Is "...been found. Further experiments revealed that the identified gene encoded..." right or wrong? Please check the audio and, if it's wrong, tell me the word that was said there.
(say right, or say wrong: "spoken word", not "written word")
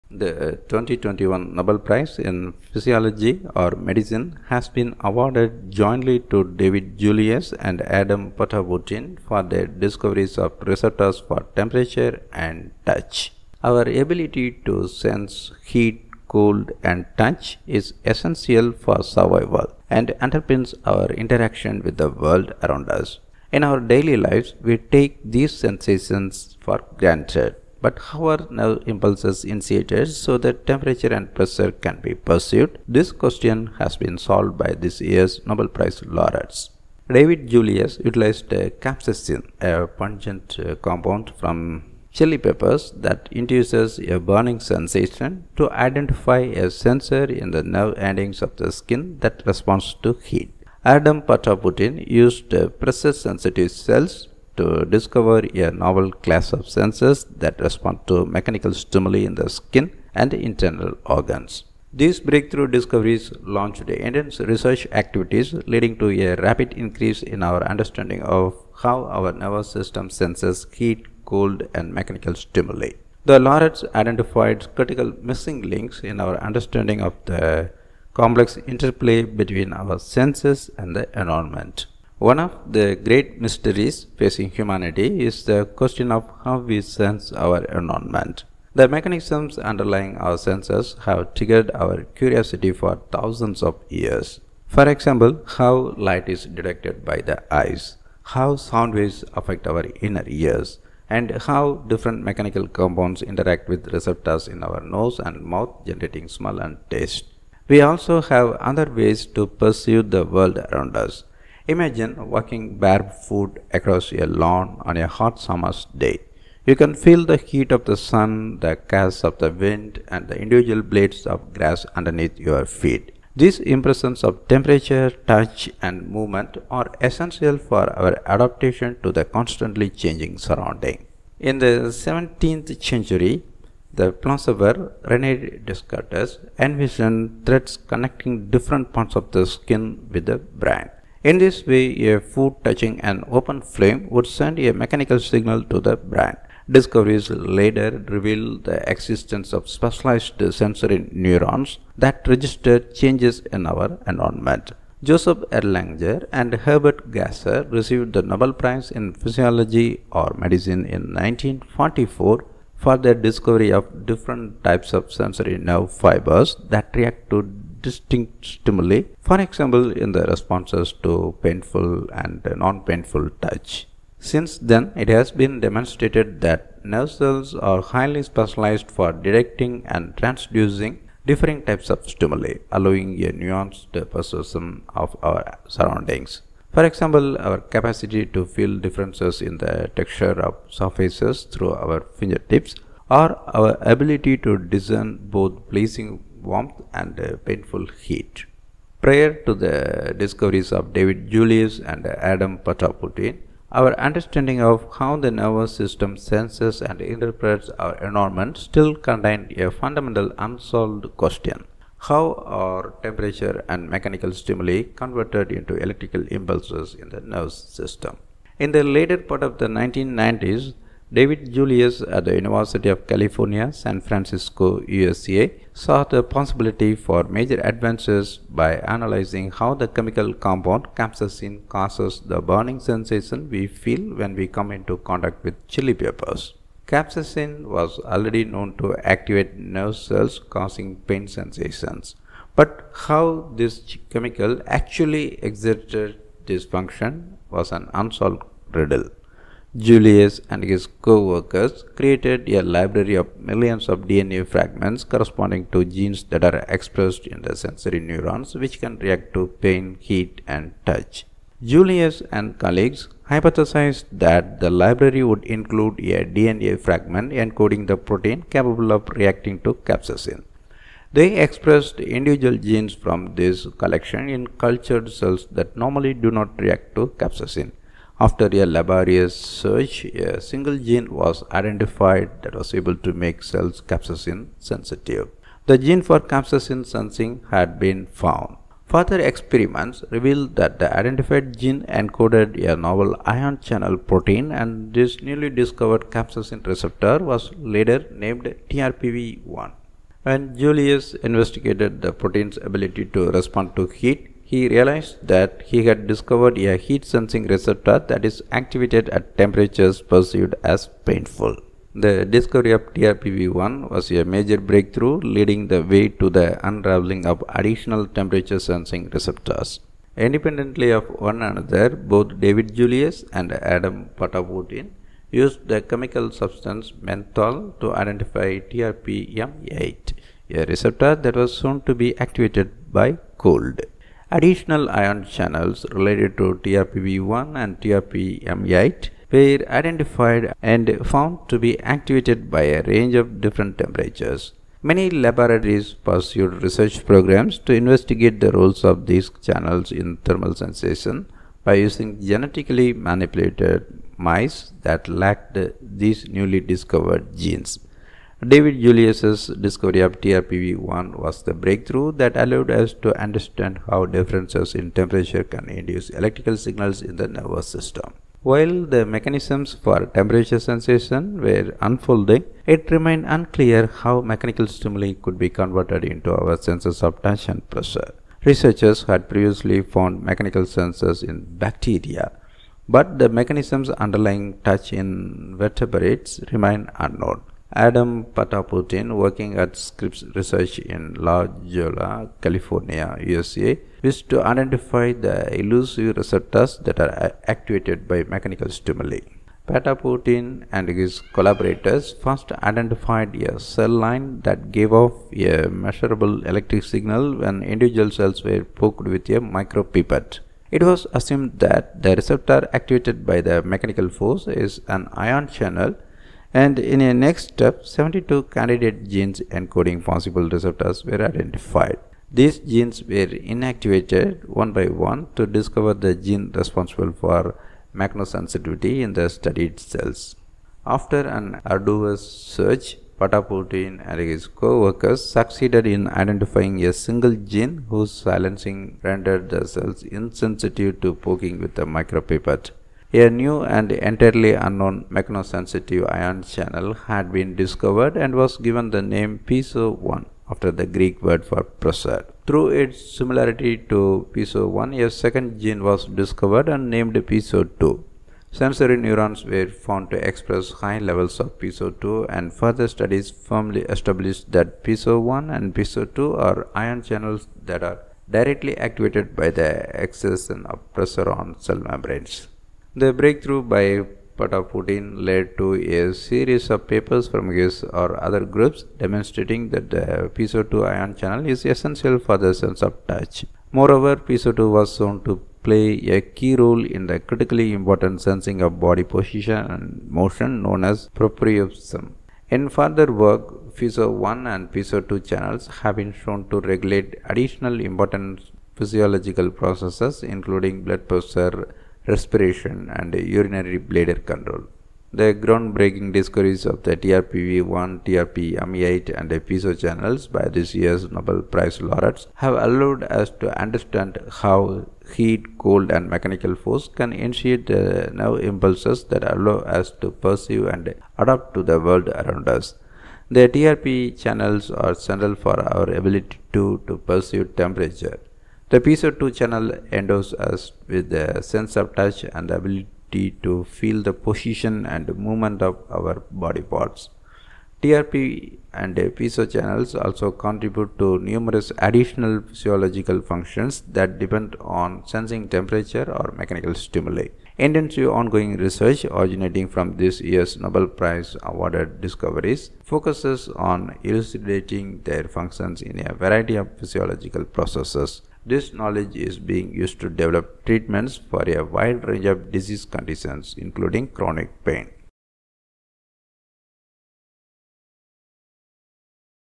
right.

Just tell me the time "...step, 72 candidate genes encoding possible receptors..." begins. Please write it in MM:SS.
06:57.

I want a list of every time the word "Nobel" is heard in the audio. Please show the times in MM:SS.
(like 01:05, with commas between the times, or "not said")
00:01, 00:35, 02:38, 08:31, 09:10.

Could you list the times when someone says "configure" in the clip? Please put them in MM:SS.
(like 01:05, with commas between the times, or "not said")
not said.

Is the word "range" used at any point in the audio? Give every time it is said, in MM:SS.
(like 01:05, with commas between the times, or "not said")
05:42, 09:22.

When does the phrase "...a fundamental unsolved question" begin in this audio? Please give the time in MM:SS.
03:29.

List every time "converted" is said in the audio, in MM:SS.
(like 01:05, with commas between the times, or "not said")
03:34, 06:15.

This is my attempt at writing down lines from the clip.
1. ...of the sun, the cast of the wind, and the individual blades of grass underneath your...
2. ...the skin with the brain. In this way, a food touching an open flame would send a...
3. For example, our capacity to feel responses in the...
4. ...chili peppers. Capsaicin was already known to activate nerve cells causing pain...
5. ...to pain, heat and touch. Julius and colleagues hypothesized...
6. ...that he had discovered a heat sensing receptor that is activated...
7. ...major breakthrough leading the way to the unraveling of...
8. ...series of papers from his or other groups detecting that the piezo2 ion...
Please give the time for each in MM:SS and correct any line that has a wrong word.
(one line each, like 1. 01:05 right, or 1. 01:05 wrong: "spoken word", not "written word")
1. 01:57 right
2. 02:19 right
3. 03:06 wrong: "differences", not "responses"
4. 03:55 right
5. 04:19 right
6. 05:05 right
7. 05:14 right
8. 07:56 wrong: "demonstrating", not "detecting".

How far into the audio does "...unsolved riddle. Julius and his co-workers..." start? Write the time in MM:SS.
04:07.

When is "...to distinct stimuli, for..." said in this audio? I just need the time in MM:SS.
02:47.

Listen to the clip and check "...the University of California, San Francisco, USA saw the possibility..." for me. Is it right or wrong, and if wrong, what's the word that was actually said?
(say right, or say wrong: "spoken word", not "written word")
right.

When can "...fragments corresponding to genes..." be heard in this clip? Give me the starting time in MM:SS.
04:14.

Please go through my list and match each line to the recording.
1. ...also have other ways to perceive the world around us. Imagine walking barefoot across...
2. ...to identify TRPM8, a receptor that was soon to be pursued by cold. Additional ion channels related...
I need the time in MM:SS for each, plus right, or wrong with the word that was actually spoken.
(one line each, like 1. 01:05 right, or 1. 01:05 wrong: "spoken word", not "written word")
1. 01:47 right
2. 05:27 wrong: "activated", not "pursued".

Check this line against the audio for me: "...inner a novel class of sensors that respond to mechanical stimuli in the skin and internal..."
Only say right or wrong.
wrong.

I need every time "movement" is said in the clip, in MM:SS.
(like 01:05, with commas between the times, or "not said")
02:06, 08:55.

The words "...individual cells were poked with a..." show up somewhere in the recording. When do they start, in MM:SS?
06:47.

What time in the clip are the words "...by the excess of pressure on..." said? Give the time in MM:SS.
07:49.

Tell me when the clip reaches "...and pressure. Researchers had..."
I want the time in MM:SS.
06:17.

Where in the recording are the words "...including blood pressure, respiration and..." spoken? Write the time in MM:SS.
08:20.